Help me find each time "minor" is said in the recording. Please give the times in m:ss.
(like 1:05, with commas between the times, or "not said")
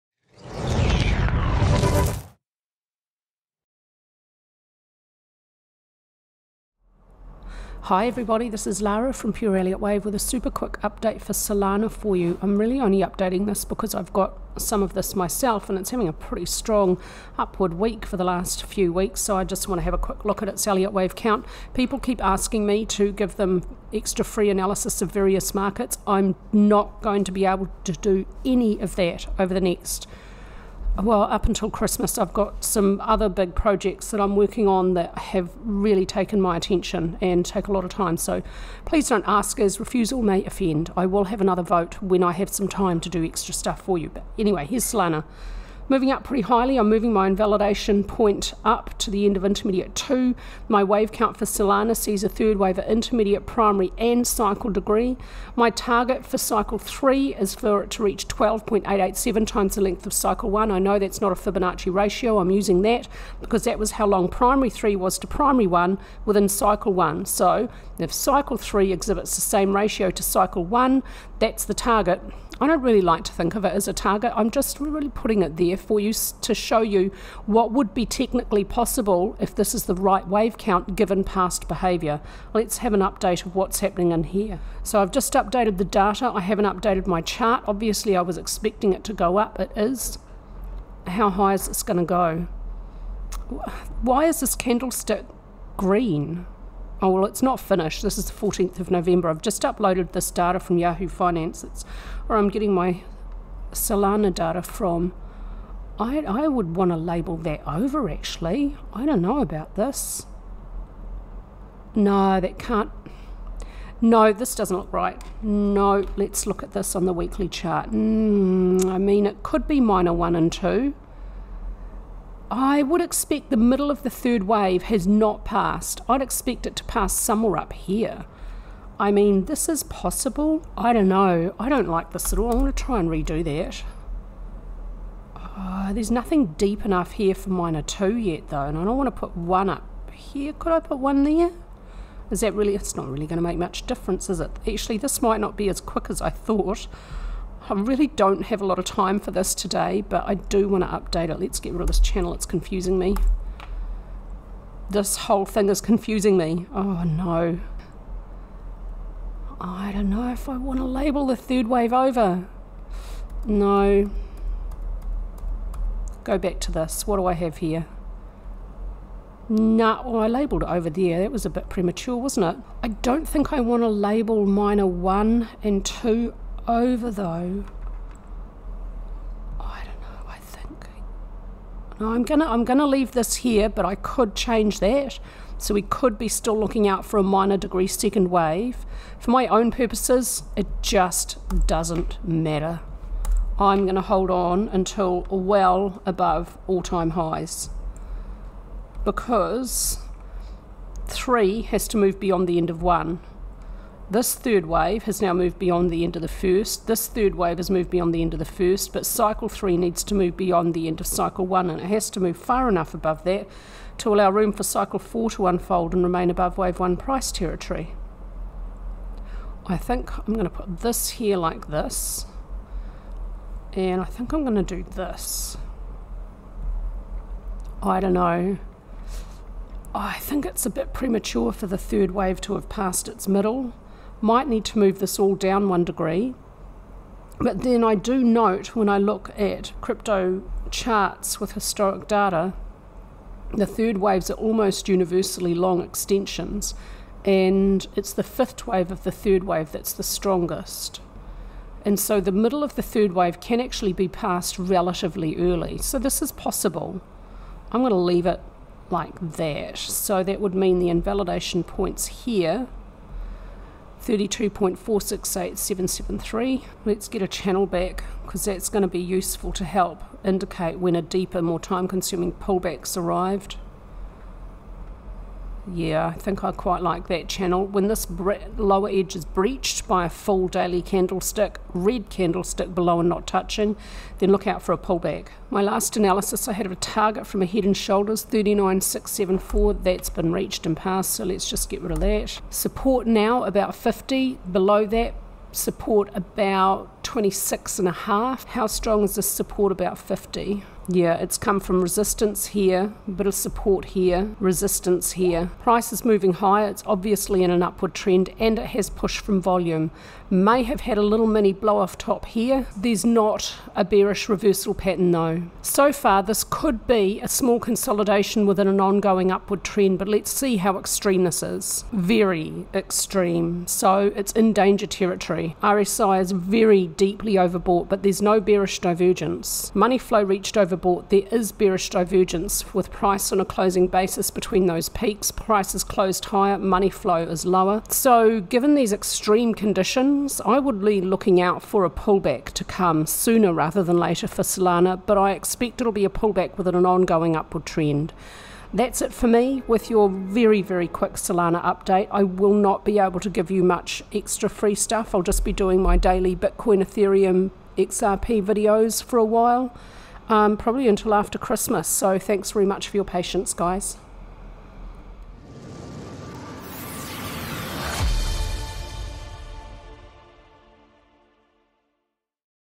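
1:59, 2:17, 2:54, 3:07.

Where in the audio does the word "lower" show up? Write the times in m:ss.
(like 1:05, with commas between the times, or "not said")
4:38, 5:37.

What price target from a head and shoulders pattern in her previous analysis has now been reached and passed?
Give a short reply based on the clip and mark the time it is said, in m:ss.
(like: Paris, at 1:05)
39674, at 4:48.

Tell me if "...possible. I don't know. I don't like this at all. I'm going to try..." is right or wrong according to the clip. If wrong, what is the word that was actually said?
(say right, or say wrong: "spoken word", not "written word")
right.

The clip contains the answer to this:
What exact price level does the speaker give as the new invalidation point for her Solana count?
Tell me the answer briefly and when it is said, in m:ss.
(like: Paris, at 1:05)
32.468773, at 4:24.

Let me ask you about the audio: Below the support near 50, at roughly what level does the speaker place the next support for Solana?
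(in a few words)
26.5.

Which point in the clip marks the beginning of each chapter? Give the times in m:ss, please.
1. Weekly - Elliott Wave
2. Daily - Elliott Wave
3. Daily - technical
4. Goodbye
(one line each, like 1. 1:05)
1. 0:11
2. 1:25
3. 4:46
4. 5:48.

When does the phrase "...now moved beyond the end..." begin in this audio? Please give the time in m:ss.
3:25.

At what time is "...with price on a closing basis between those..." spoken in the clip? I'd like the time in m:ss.
5:32.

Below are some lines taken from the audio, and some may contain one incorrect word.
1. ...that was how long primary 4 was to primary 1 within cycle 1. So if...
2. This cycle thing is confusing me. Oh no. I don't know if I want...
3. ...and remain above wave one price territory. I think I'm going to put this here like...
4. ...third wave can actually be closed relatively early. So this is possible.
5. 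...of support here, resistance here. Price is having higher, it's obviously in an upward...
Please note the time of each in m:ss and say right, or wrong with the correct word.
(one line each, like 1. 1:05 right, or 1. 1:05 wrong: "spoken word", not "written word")
1. 1:03 wrong: "3", not "4"
2. 2:34 wrong: "whole", not "cycle"
3. 3:35 right
4. 4:12 wrong: "passed", not "closed"
5. 5:03 wrong: "moving", not "having".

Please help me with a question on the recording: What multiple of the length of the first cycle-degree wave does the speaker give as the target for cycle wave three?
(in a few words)
12.887.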